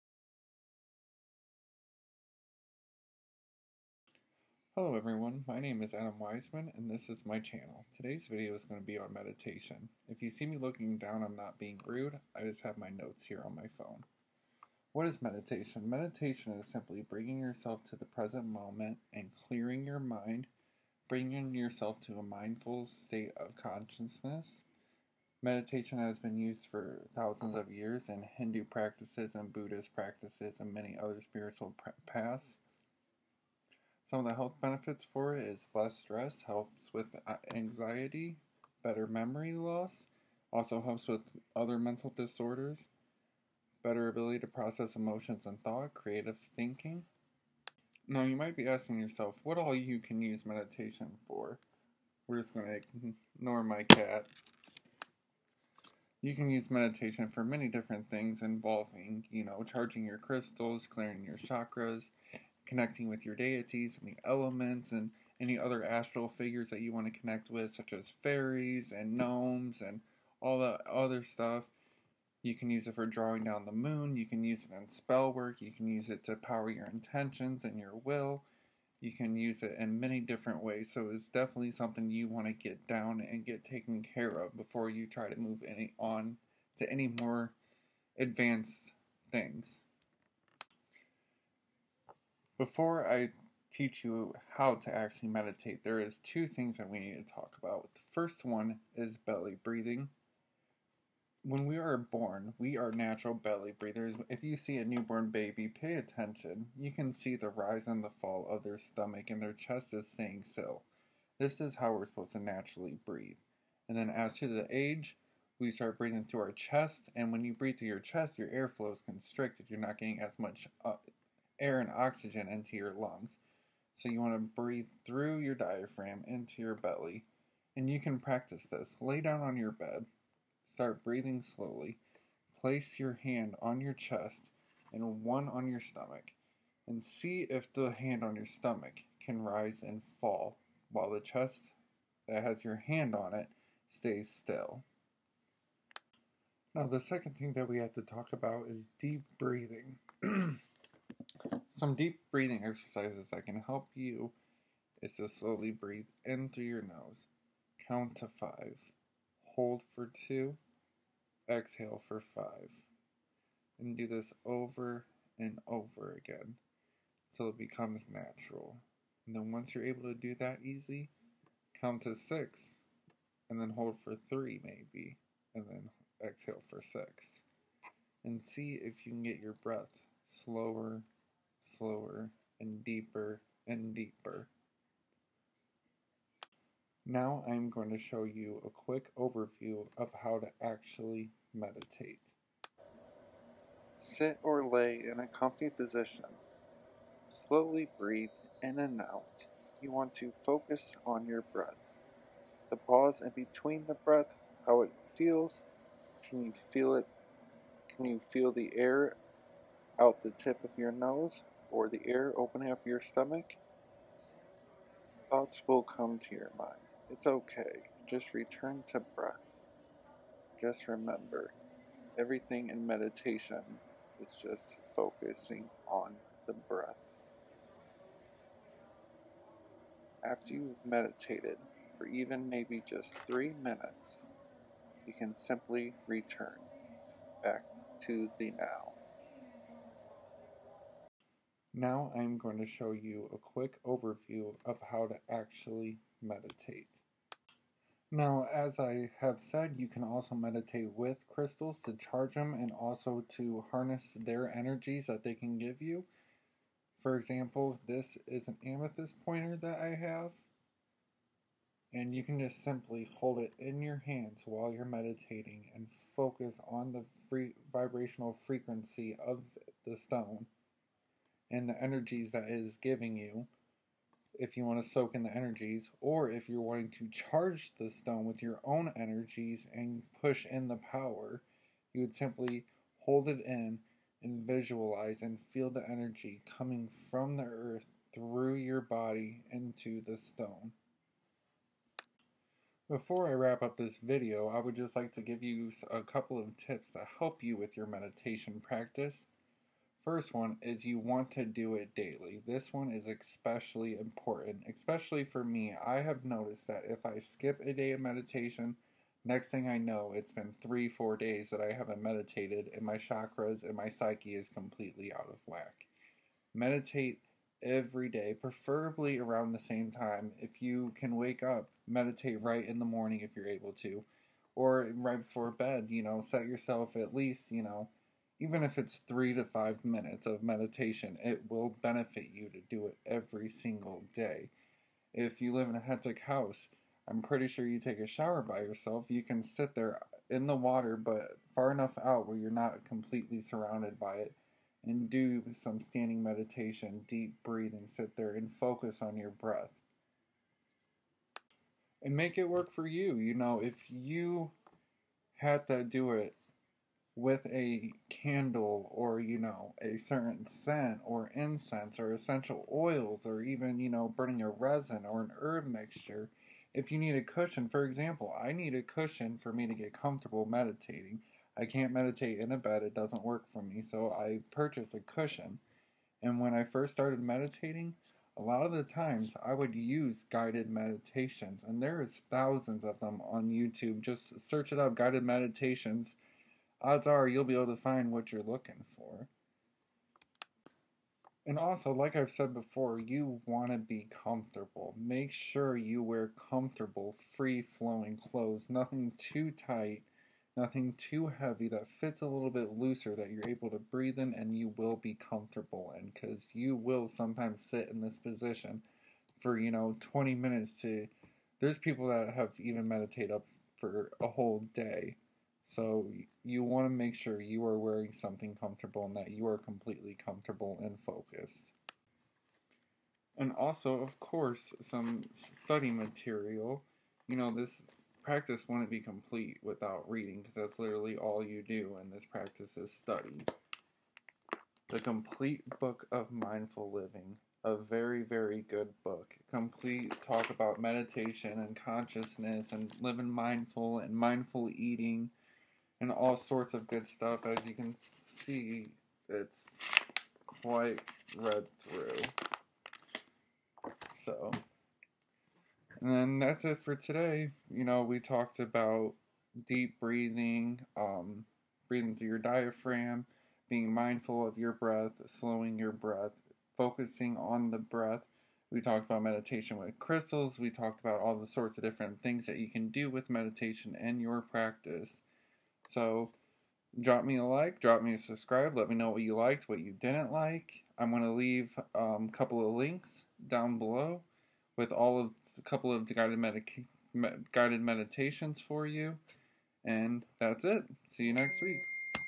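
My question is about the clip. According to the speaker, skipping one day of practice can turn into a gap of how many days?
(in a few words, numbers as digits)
3 or 4.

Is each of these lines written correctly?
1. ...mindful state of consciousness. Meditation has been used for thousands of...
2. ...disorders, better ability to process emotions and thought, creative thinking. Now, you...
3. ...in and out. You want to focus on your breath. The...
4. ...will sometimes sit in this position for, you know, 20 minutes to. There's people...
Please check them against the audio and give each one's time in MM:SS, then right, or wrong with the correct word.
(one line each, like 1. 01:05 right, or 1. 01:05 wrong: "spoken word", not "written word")
1. 00:22 right
2. 00:42 right
3. 03:18 right
4. 06:46 right.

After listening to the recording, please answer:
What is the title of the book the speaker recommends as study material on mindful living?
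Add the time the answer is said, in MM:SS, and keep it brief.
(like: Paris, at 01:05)
The Complete Book of Mindful Living, at 07:14.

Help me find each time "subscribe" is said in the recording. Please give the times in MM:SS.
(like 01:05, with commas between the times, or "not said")
07:58.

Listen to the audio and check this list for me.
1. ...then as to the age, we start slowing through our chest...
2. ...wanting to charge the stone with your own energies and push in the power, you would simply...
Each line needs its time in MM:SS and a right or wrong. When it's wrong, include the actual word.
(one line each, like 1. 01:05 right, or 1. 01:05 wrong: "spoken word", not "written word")
1. 01:53 wrong: "breathing", not "slowing"
2. 04:36 right.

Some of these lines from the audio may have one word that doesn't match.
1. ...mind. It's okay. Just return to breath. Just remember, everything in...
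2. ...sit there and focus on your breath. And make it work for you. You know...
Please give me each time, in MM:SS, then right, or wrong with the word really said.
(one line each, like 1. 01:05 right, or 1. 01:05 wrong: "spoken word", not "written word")
1. 03:36 right
2. 05:47 right.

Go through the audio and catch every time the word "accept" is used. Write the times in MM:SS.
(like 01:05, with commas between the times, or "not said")
not said.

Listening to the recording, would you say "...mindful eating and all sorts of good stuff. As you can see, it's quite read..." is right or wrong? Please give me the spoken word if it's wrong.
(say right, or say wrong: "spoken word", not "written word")
right.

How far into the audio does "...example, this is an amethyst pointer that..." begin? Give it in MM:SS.
04:17.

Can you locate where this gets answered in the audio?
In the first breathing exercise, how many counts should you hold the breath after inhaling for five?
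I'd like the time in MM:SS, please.
02:39.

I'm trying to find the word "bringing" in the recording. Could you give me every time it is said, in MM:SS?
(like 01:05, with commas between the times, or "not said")
00:17, 00:21.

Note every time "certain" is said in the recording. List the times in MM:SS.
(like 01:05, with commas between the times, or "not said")
05:59.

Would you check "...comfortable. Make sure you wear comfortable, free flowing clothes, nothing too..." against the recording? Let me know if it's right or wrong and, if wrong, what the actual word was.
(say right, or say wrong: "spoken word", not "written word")
right.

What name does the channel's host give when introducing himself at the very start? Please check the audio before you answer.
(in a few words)
Adam Wiseman.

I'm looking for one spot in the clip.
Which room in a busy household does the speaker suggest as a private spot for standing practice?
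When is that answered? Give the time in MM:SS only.
05:38.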